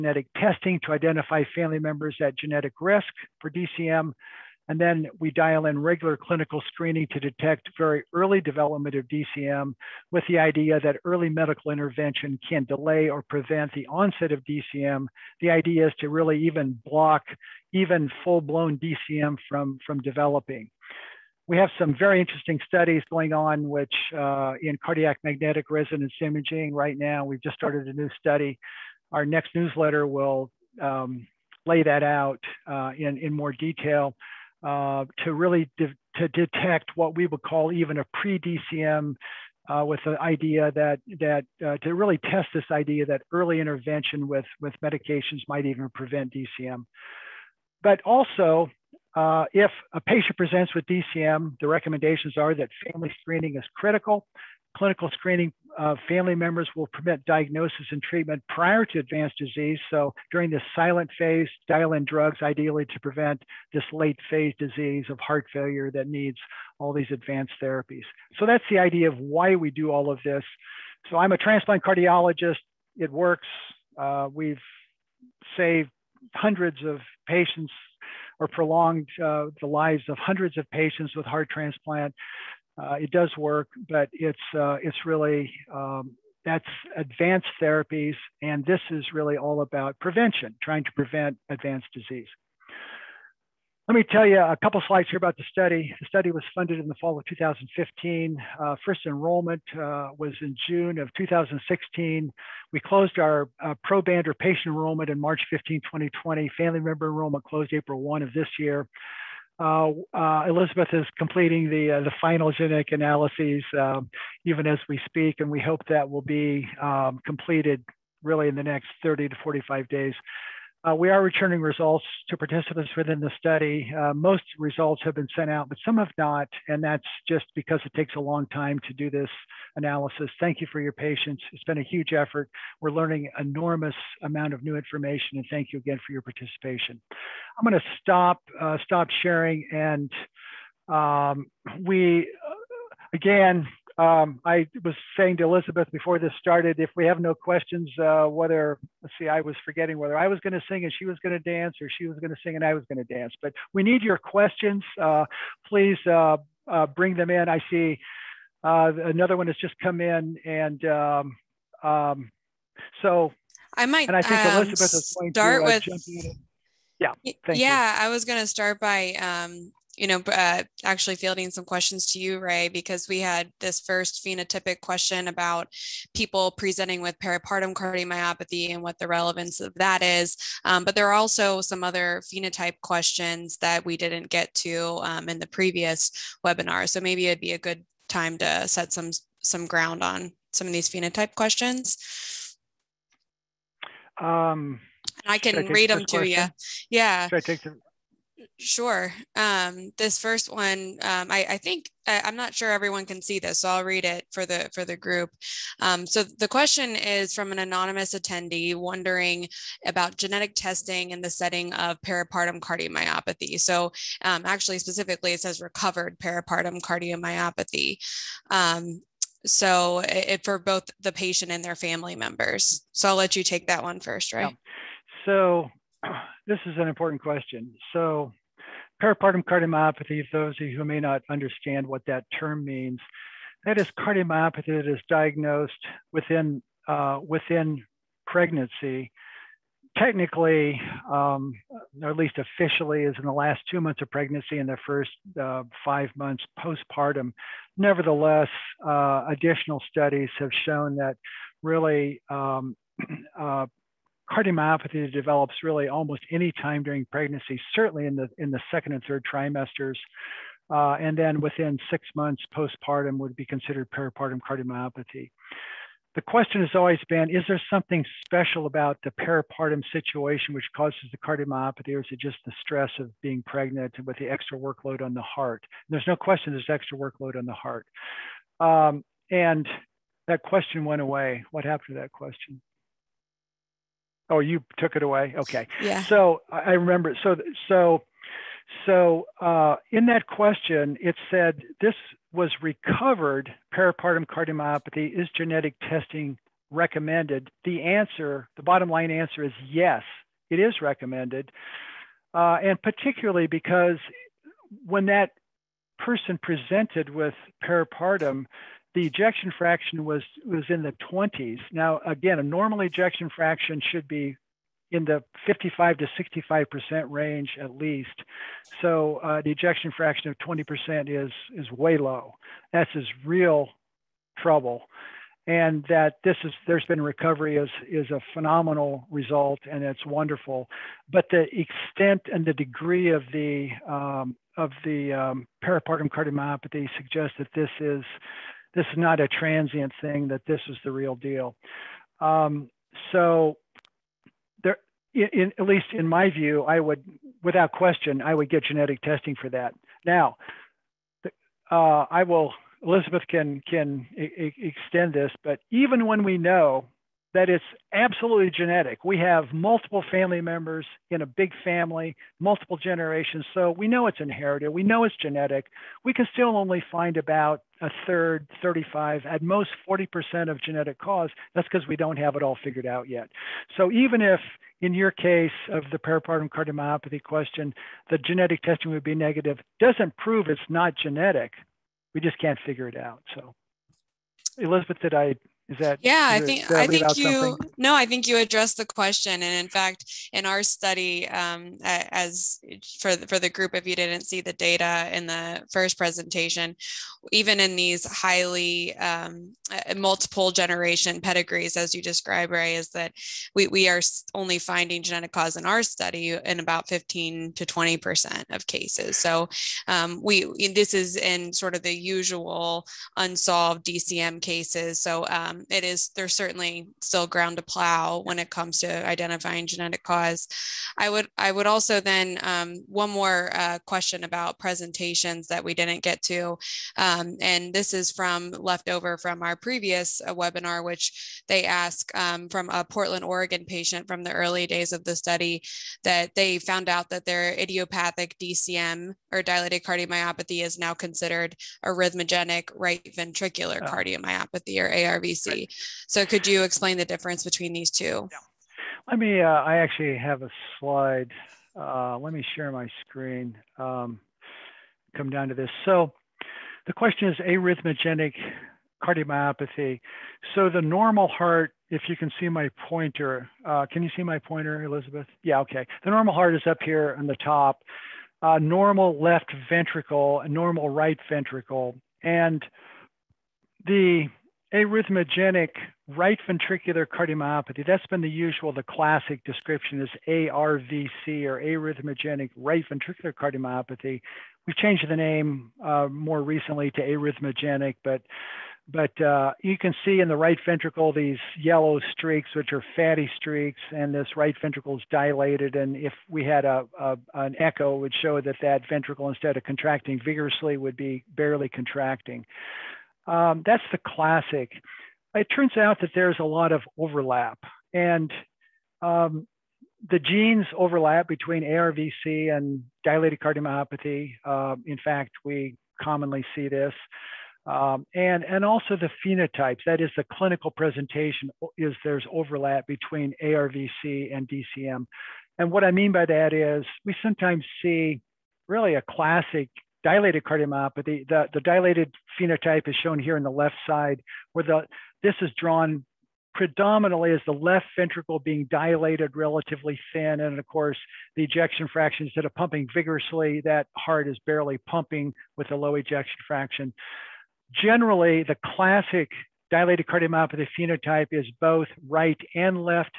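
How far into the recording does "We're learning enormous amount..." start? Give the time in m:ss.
2:12.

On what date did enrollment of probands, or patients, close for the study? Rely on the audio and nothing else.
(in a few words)
March 15, 2020.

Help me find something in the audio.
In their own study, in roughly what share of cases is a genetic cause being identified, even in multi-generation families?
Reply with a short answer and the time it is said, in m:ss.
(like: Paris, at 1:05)
15 to 20 percent, at 6:46.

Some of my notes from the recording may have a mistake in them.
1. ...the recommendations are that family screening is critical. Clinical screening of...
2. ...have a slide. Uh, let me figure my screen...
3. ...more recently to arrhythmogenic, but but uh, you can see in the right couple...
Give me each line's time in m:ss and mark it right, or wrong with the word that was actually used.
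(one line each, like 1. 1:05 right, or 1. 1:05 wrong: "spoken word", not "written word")
1. 0:51 right
2. 7:30 wrong: "share", not "figure"
3. 8:06 wrong: "ventricle", not "couple".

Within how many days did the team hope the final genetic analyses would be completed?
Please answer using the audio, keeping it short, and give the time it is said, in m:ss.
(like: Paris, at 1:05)
30 to 45 days, at 1:59.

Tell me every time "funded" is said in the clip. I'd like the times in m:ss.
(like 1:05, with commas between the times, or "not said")
1:36.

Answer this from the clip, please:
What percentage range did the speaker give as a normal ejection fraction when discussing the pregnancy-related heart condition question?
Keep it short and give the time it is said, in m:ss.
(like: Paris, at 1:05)
55 to 65 percent, at 5:15.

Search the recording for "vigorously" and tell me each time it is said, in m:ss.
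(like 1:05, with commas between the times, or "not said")
8:20, 9:02.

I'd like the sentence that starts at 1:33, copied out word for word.
Let me tell you a couple slides here about the study.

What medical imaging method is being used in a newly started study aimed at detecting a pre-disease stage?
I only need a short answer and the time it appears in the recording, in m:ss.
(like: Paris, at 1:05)
cardiac magnetic resonance imaging, at 0:24.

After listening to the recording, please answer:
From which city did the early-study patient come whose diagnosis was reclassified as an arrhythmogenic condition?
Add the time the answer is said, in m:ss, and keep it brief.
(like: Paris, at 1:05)
Portland, Oregon, at 7:12.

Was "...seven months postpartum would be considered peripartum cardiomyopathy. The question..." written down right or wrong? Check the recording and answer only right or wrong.
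wrong.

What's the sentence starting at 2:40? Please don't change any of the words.
And um, um, so I might and I think um, Elizabeth is going start to, uh, with.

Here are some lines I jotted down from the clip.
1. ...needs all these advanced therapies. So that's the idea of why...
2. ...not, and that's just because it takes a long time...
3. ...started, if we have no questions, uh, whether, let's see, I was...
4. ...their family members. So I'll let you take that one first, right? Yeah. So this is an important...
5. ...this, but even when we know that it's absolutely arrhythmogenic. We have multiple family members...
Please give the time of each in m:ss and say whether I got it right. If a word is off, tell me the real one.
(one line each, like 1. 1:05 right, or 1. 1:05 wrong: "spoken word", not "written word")
1. 1:06 right
2. 2:06 right
3. 2:26 right
4. 3:41 right
5. 5:55 wrong: "genetic", not "arrhythmogenic".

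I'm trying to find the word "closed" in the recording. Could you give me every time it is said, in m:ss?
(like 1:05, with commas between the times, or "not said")
1:42, 1:47.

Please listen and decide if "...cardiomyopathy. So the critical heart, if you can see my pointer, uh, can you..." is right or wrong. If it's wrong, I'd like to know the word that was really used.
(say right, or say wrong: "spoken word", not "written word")
wrong: "normal", not "critical".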